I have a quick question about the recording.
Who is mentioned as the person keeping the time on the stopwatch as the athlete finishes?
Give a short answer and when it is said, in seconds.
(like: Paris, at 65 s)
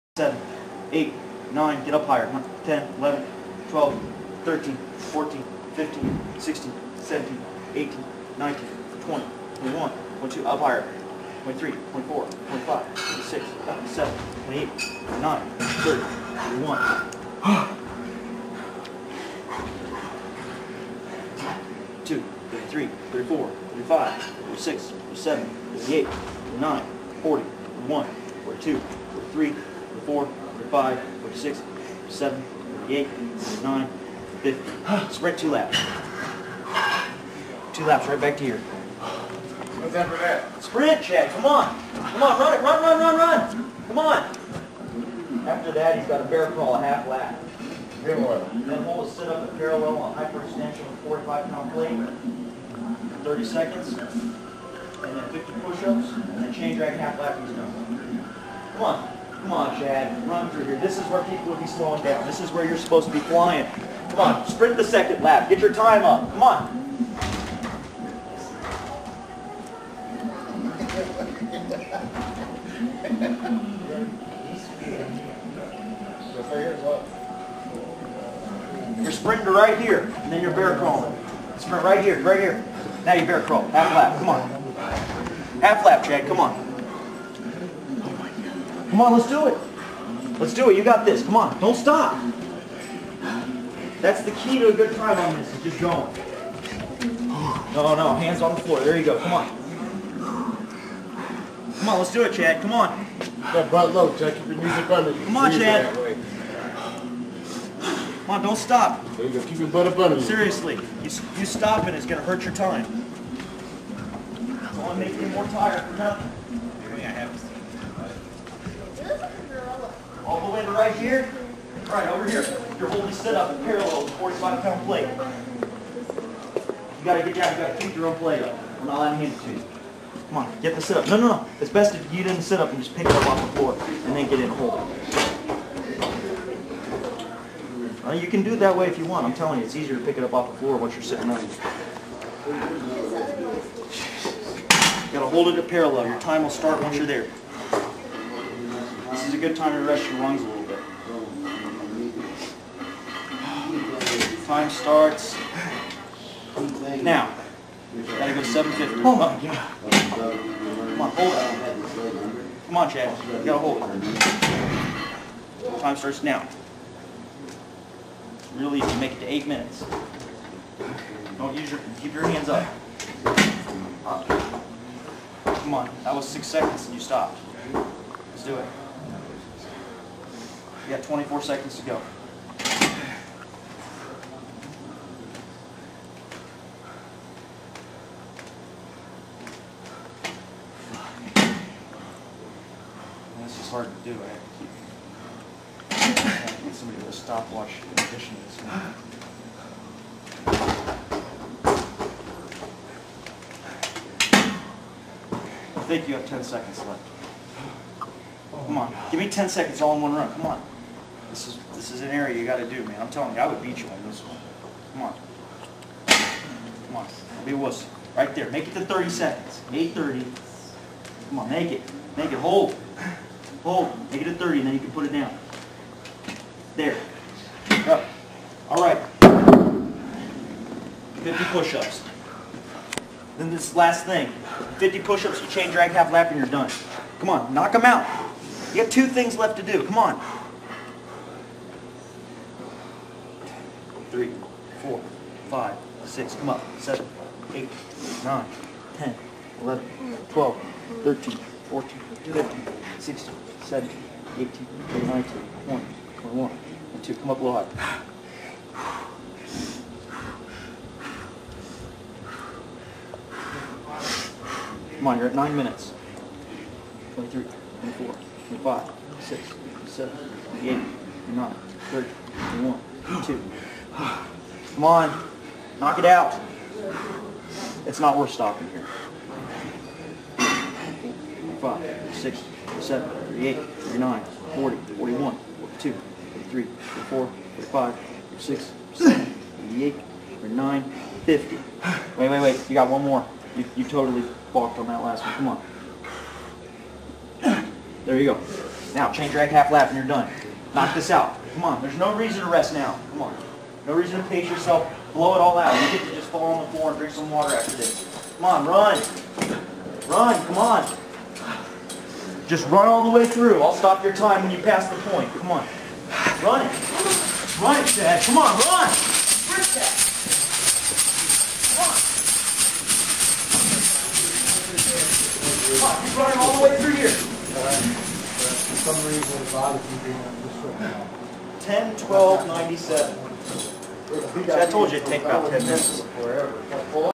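Bob, at 329 s.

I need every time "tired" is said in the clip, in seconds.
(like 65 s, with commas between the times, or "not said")
115 s.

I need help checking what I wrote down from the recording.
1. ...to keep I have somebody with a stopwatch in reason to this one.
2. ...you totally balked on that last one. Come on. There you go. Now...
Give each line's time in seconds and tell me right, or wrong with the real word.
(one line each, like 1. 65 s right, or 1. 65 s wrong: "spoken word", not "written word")
1. 194 s wrong: "addition", not "reason"
2. 293 s right.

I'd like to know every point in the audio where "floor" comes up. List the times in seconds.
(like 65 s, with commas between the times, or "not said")
98 s, 133 s, 140 s, 306 s.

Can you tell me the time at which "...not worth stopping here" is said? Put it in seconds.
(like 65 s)
277 s.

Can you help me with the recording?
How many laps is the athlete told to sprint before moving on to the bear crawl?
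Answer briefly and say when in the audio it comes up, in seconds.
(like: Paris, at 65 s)
2 laps, at 35 s.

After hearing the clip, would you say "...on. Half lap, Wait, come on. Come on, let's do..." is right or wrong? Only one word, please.
wrong.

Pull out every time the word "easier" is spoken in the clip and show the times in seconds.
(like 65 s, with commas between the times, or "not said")
139 s.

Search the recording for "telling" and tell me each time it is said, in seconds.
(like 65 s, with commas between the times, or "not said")
139 s, 213 s.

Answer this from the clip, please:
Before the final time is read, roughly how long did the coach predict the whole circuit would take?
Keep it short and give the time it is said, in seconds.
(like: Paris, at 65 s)
About 10 minutes, at 335 s.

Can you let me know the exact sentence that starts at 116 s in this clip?
I have all the way to right here.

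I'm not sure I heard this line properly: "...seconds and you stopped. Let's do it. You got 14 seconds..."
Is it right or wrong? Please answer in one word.
wrong.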